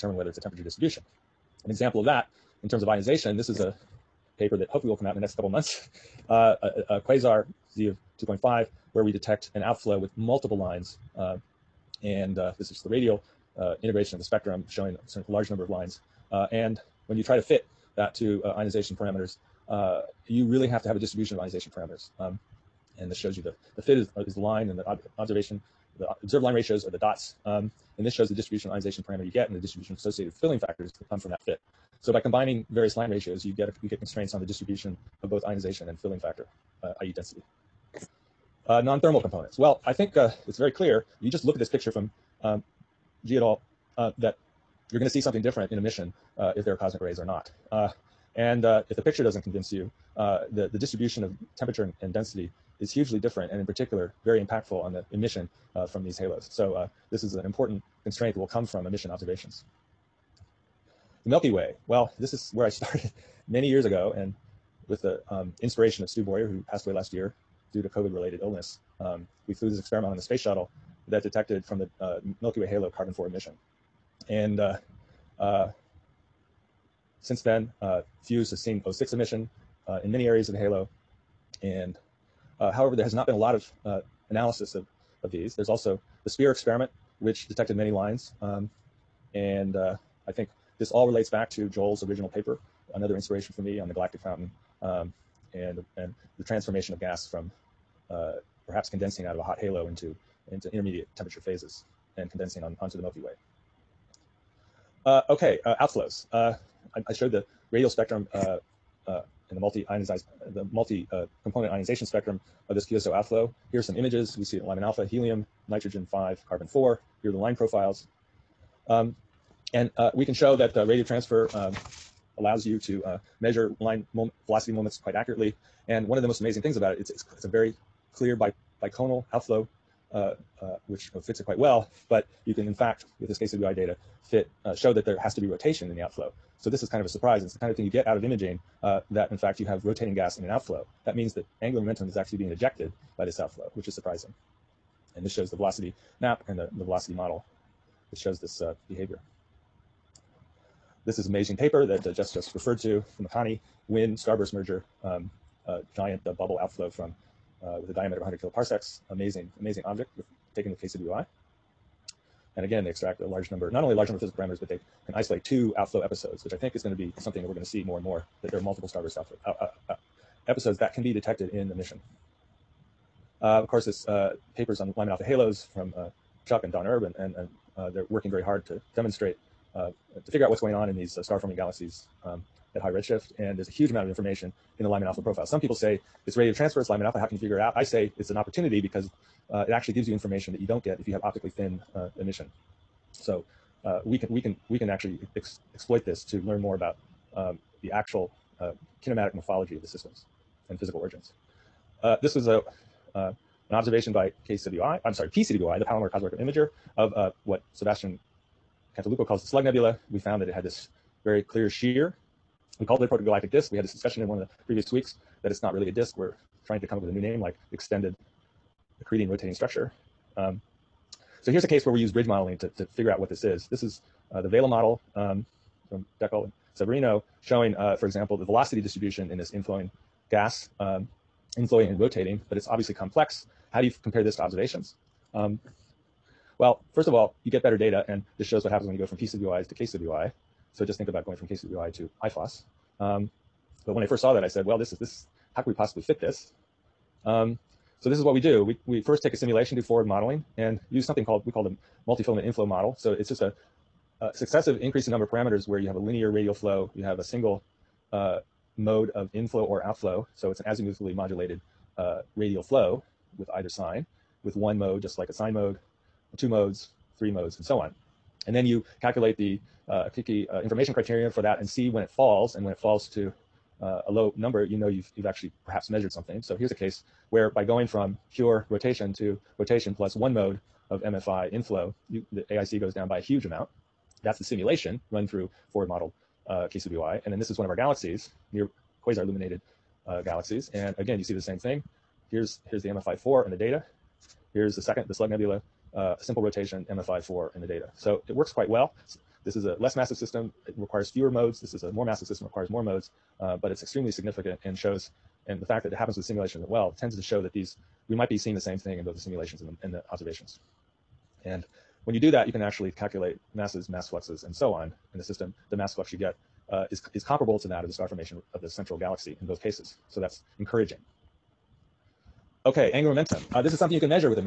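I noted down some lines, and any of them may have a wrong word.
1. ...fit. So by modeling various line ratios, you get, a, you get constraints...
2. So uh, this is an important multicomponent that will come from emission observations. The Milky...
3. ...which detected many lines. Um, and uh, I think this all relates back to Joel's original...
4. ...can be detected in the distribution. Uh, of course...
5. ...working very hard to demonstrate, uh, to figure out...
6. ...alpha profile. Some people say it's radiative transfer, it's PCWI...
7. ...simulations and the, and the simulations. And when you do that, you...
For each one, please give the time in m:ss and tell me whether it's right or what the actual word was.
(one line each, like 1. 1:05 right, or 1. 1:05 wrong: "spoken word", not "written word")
1. 0:31 wrong: "combining", not "modeling"
2. 0:56 wrong: "constraint", not "multicomponent"
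3. 1:27 right
4. 2:50 wrong: "mission", not "distribution"
5. 2:58 right
6. 3:05 wrong: "Lyman", not "PCWI"
7. 5:09 wrong: "observations", not "simulations".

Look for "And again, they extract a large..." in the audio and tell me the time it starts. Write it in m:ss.
2:42.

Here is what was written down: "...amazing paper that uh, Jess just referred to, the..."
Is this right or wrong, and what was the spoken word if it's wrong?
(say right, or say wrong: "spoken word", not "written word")
right.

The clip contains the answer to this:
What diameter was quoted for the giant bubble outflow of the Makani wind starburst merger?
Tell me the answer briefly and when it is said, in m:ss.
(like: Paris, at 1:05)
100 kiloparsecs, at 2:38.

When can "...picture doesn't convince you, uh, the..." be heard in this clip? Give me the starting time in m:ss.
0:49.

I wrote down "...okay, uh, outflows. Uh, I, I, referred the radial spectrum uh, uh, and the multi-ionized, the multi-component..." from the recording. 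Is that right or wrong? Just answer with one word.
wrong.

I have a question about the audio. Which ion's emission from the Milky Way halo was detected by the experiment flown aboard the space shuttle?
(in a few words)
carbon-4.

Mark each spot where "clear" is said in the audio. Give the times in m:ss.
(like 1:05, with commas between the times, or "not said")
0:40, 2:08, 3:31.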